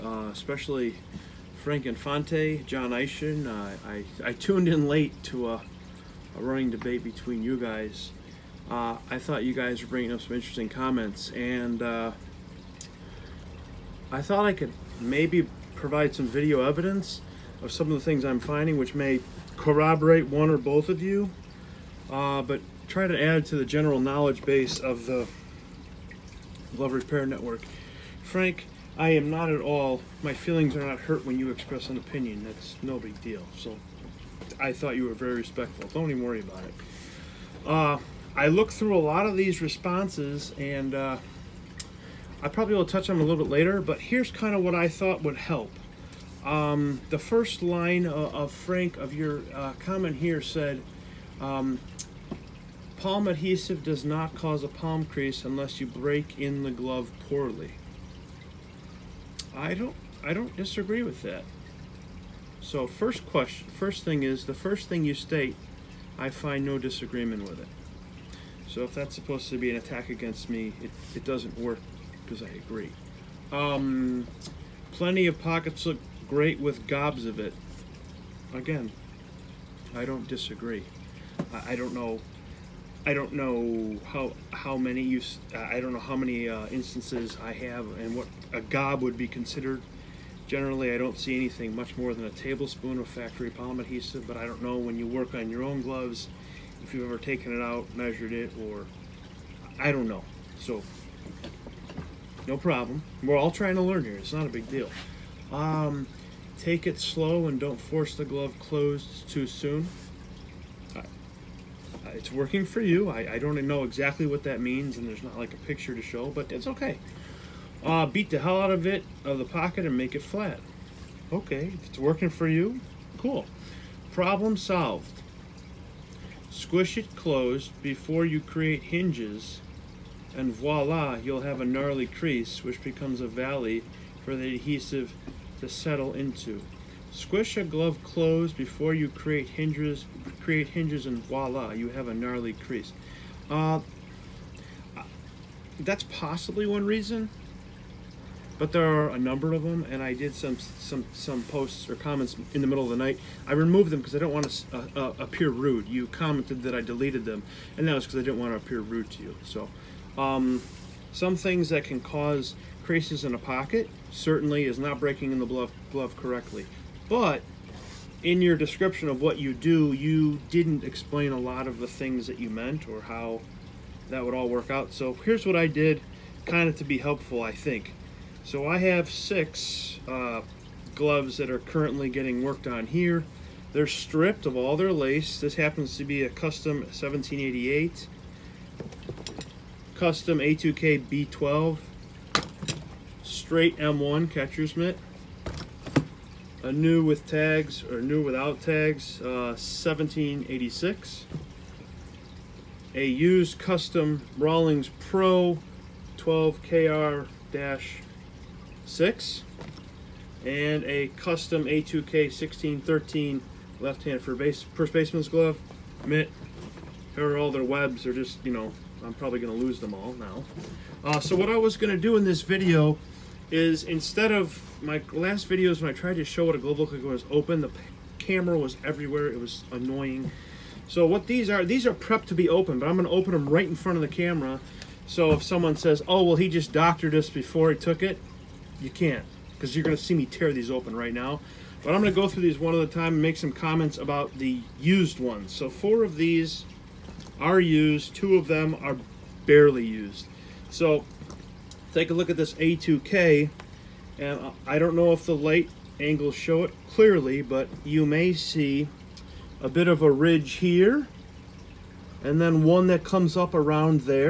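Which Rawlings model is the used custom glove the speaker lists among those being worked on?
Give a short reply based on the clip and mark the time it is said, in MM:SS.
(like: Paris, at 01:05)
Pro 12KR-6, at 03:24.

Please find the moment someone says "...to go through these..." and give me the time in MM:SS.
04:02.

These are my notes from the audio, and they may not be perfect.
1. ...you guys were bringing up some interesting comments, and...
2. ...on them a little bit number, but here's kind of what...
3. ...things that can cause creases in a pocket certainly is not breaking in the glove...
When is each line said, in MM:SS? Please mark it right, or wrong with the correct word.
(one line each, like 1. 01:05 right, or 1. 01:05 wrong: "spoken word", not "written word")
1. 00:09 right
2. 00:43 wrong: "later", not "number"
3. 02:41 right.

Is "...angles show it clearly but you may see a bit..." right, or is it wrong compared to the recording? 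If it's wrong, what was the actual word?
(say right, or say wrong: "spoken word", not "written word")
right.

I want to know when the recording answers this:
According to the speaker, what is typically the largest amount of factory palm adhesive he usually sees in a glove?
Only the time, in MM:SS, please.
01:32.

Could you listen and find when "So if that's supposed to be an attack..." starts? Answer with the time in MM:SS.
01:08.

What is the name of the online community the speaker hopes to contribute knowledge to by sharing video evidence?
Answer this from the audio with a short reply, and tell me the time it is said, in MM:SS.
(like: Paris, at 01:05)
Glove Repair Network, at 00:26.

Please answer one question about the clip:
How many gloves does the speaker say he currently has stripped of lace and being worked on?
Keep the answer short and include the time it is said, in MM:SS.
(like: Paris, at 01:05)
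6, at 02:59.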